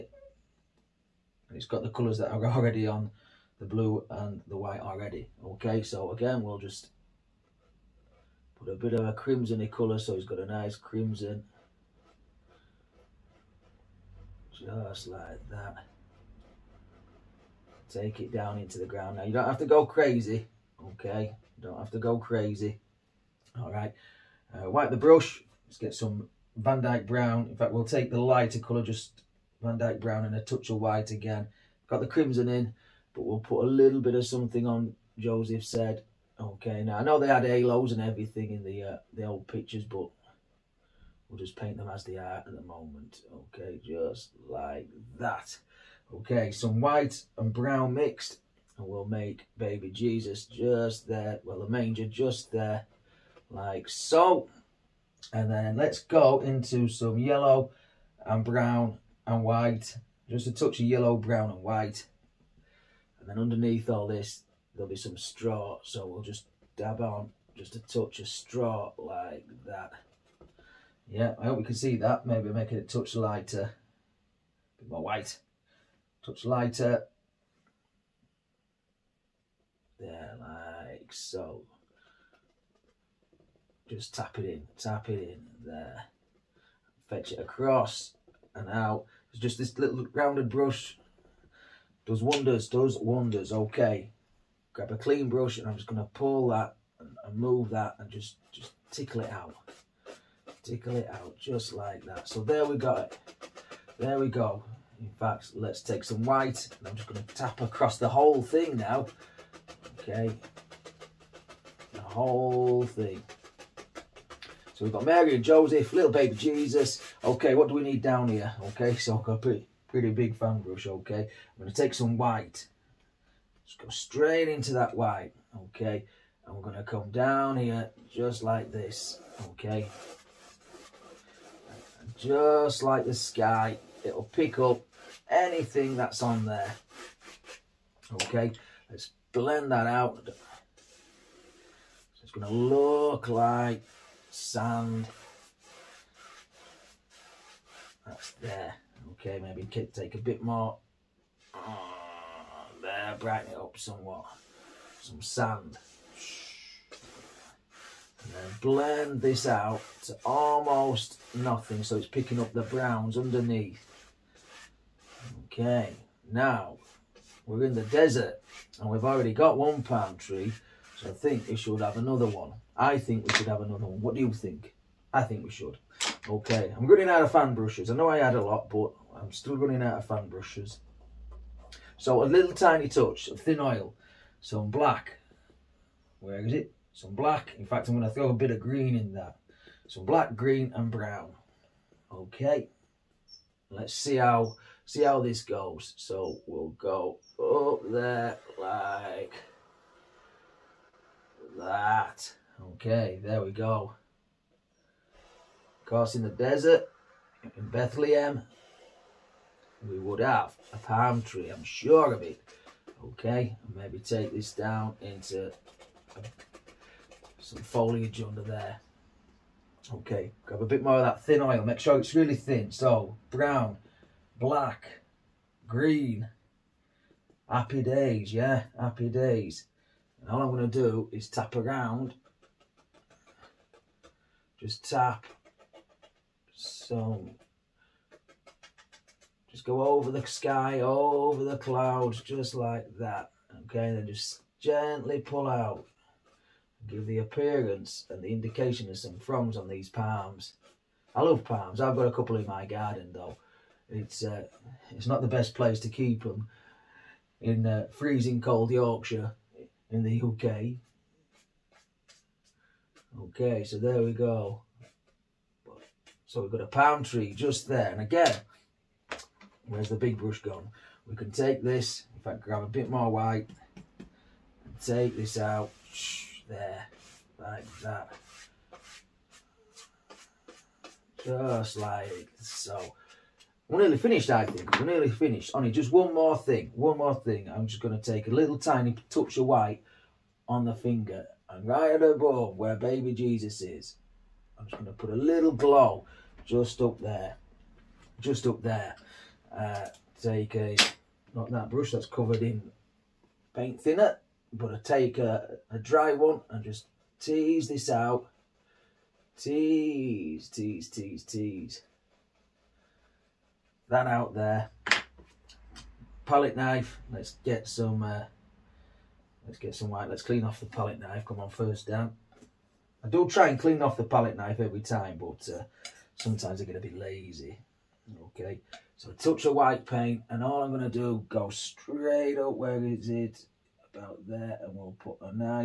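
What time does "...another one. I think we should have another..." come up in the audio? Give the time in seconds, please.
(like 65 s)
171 s.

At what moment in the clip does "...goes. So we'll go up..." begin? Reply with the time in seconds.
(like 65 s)
195 s.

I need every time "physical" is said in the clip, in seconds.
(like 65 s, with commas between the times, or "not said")
not said.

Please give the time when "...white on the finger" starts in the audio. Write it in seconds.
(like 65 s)
289 s.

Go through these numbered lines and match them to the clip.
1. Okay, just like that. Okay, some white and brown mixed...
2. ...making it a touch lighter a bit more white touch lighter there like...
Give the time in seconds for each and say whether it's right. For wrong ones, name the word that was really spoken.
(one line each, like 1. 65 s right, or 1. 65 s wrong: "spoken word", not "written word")
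1. 43 s right
2. 72 s right.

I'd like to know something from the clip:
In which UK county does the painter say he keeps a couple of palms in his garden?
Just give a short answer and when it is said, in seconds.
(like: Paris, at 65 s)
Yorkshire, at 258 s.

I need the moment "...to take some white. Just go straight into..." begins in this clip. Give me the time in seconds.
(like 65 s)
121 s.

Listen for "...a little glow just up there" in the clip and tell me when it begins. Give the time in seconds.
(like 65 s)
295 s.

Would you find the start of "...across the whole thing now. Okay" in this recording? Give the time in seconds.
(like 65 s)
107 s.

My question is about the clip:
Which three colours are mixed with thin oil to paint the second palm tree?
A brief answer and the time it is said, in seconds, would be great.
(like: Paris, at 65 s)
black, green and brown, at 190 s.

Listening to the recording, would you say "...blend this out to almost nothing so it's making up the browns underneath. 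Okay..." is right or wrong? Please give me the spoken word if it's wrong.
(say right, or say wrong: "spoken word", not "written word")
wrong: "picking", not "making".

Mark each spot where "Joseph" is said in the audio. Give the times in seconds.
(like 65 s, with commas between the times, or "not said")
35 s, 115 s.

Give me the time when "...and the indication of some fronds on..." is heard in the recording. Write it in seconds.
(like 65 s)
248 s.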